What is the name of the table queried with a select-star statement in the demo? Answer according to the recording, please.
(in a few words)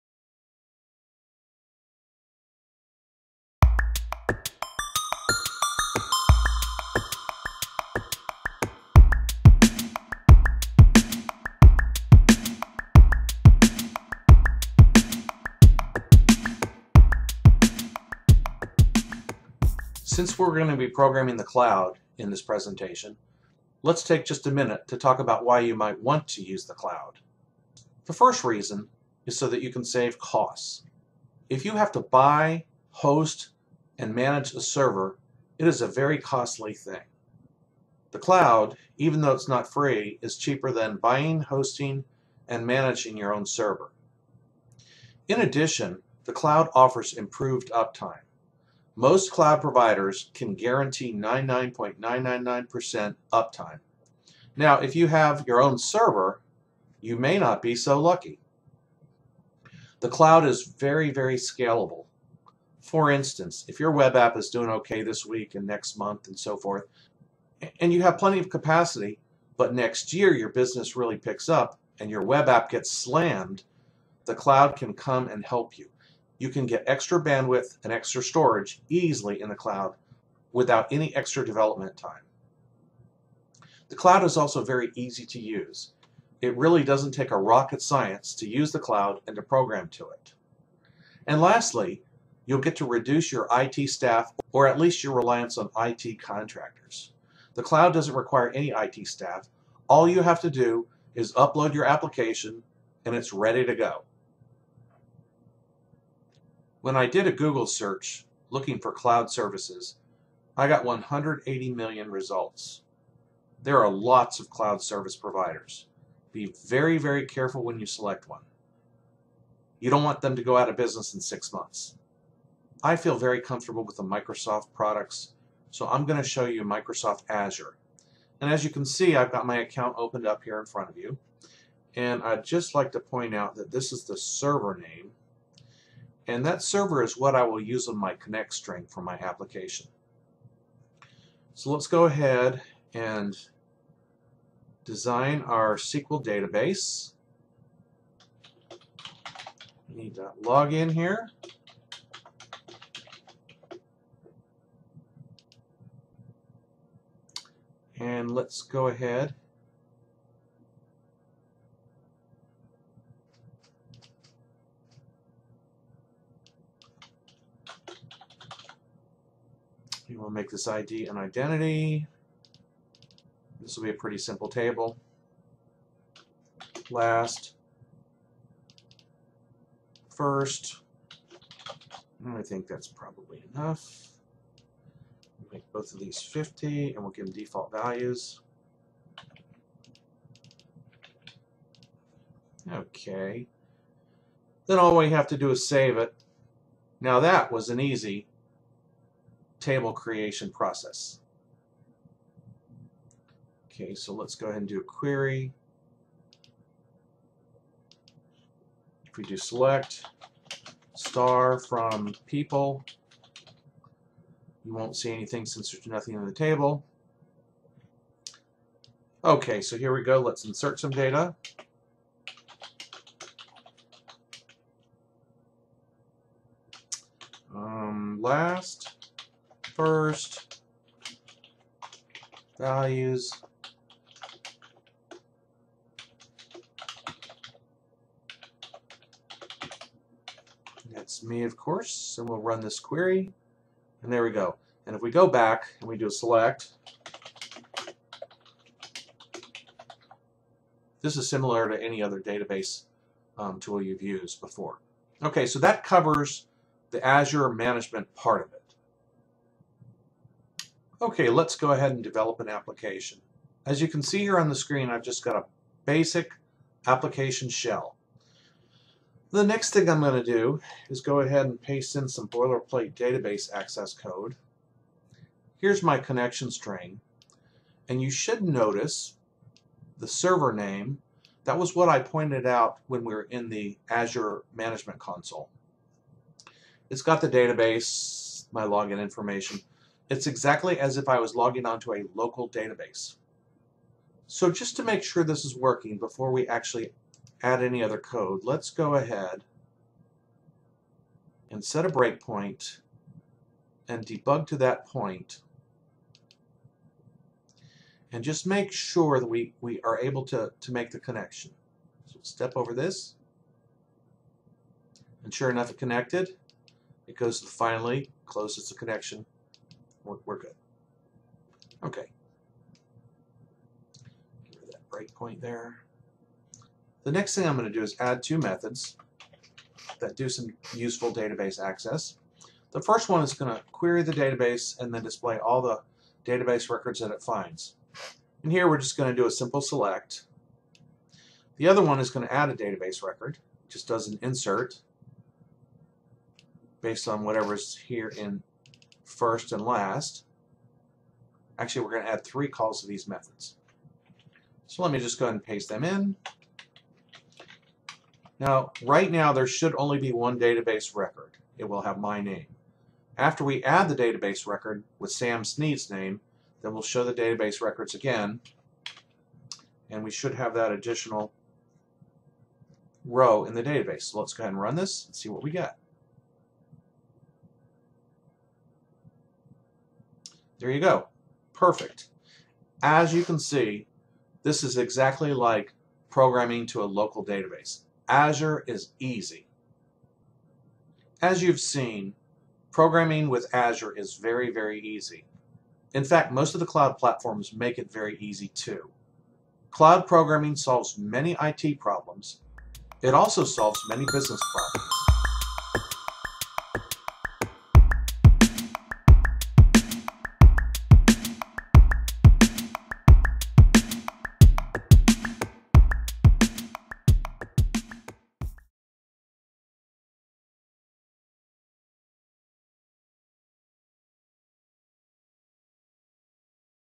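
people.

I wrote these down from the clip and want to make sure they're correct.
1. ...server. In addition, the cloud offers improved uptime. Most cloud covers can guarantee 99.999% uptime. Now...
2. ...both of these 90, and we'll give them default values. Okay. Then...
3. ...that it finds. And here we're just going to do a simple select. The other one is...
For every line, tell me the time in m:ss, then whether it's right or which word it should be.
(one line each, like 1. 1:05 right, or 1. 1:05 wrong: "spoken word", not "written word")
1. 0:43 wrong: "providers", not "covers"
2. 3:05 wrong: "50", not "90"
3. 5:36 right.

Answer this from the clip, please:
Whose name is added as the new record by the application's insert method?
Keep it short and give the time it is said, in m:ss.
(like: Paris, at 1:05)
Sam Sneed, at 6:05.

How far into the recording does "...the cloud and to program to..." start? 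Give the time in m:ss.
1:28.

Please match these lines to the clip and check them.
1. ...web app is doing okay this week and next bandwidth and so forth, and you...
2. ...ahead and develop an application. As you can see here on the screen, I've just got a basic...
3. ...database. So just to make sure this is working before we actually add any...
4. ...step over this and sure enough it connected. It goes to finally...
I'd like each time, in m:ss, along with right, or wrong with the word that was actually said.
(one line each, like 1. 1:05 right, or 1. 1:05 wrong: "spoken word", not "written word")
1. 1:03 wrong: "month", not "bandwidth"
2. 4:21 right
3. 4:52 right
4. 5:12 right.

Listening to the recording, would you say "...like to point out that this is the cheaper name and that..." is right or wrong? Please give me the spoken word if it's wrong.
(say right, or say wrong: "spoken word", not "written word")
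wrong: "server", not "cheaper".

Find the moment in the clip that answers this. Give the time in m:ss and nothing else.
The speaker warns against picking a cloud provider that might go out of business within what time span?
2:01.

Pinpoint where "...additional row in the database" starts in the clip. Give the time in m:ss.
6:10.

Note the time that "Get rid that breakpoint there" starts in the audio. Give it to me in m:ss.
5:24.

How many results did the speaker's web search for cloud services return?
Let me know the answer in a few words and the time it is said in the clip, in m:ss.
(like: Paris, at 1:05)
180 million, at 1:50.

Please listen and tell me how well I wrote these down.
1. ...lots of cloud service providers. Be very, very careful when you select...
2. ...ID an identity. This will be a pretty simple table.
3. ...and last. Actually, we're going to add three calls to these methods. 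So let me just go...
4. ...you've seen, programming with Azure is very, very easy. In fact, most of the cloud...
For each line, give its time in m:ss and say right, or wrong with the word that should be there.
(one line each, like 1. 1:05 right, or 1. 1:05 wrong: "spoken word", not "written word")
1. 1:53 right
2. 2:50 right
3. 5:49 right
4. 6:31 right.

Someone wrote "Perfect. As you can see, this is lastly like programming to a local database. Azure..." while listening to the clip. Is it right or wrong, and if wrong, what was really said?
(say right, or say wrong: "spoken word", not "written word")
wrong: "exactly", not "lastly".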